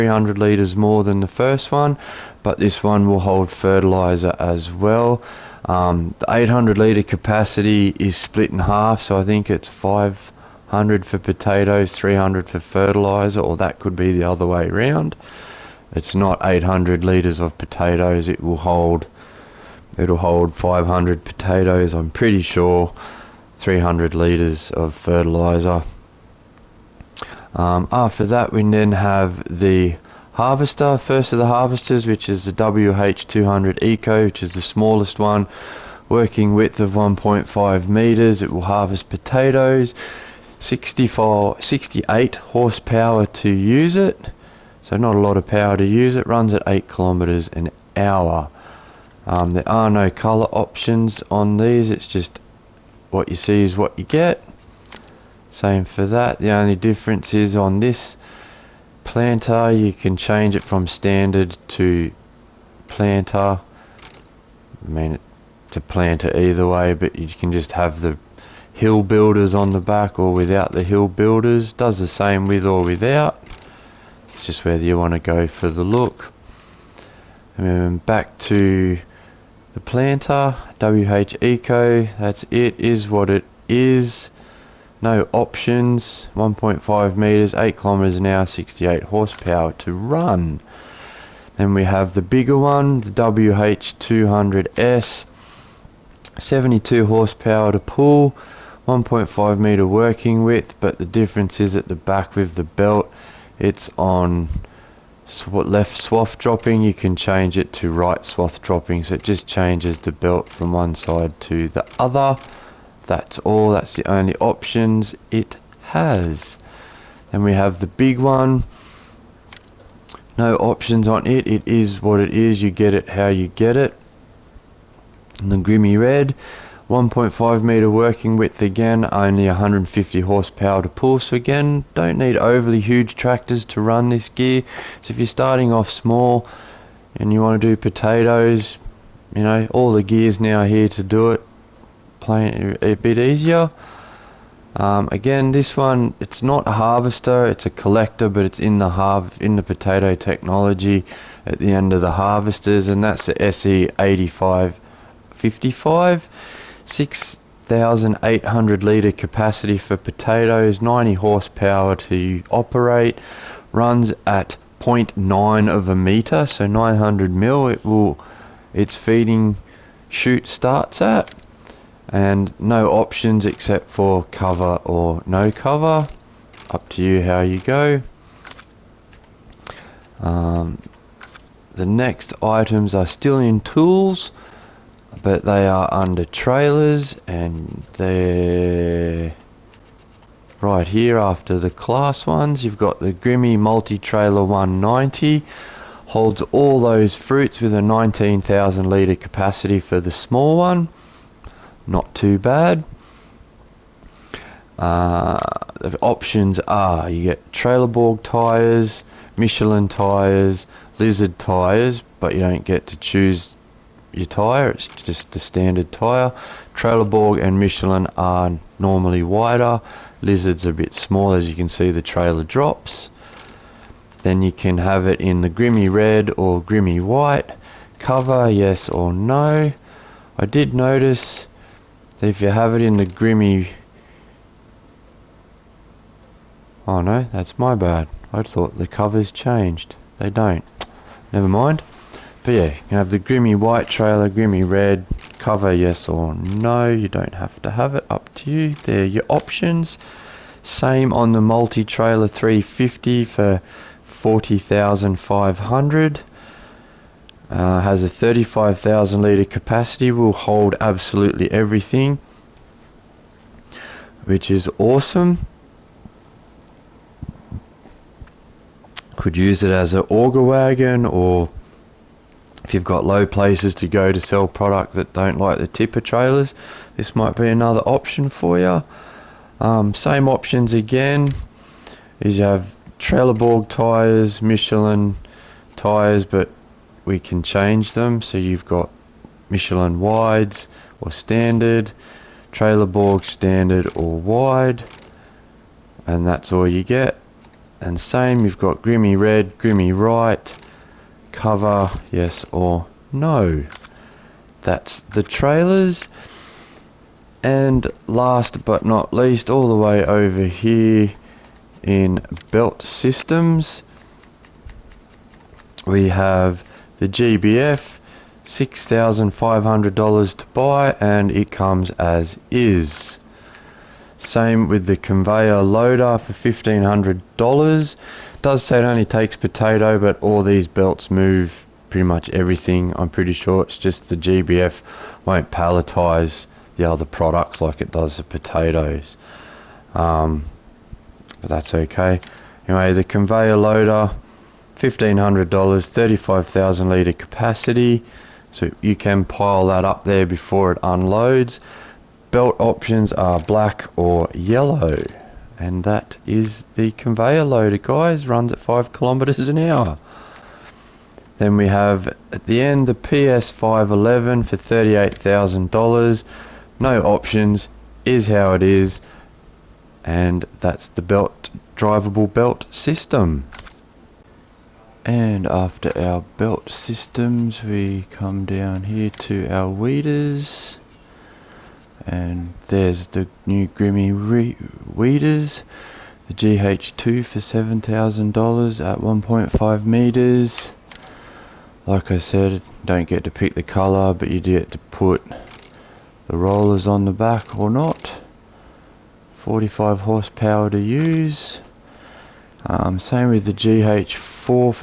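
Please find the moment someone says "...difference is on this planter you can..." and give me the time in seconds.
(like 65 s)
56 s.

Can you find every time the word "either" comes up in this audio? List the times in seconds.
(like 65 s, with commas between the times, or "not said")
66 s.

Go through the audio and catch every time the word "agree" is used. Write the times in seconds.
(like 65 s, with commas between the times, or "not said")
not said.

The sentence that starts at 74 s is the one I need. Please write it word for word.
It's just whether you want to go for the look.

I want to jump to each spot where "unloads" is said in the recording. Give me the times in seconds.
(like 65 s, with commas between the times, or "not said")
350 s.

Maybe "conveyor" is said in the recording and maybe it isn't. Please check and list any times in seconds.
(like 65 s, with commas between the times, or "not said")
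324 s, 343 s, 356 s.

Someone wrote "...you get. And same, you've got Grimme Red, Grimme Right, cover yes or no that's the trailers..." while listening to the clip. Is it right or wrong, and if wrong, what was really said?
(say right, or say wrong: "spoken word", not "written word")
right.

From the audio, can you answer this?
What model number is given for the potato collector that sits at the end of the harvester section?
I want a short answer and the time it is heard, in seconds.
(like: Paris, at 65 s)
SE8555, at 153 s.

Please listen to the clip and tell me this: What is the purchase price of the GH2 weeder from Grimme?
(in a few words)
$7,000.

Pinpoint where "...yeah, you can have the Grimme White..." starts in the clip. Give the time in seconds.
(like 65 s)
242 s.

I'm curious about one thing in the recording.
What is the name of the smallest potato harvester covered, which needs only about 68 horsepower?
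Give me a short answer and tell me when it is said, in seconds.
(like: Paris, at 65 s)
WH200 Eco, at 32 s.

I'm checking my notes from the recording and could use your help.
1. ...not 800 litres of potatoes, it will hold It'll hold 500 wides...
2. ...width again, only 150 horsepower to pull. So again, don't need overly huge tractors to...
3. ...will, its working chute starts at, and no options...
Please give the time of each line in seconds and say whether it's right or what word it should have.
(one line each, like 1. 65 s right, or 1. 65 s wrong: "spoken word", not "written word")
1. 16 s wrong: "potatoes", not "wides"
2. 128 s right
3. 167 s wrong: "feeding", not "working".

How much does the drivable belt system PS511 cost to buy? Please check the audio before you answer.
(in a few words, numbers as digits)
$38,000.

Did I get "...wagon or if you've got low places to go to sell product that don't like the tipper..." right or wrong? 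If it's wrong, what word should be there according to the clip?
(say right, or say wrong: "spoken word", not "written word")
right.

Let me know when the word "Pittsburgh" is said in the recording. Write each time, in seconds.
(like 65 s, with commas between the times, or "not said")
not said.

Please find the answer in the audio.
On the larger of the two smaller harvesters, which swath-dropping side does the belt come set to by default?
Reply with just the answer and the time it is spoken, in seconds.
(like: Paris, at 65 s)
Left, at 105 s.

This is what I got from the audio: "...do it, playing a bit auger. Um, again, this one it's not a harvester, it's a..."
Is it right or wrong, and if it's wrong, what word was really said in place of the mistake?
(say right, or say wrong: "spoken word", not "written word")
wrong: "easier", not "auger".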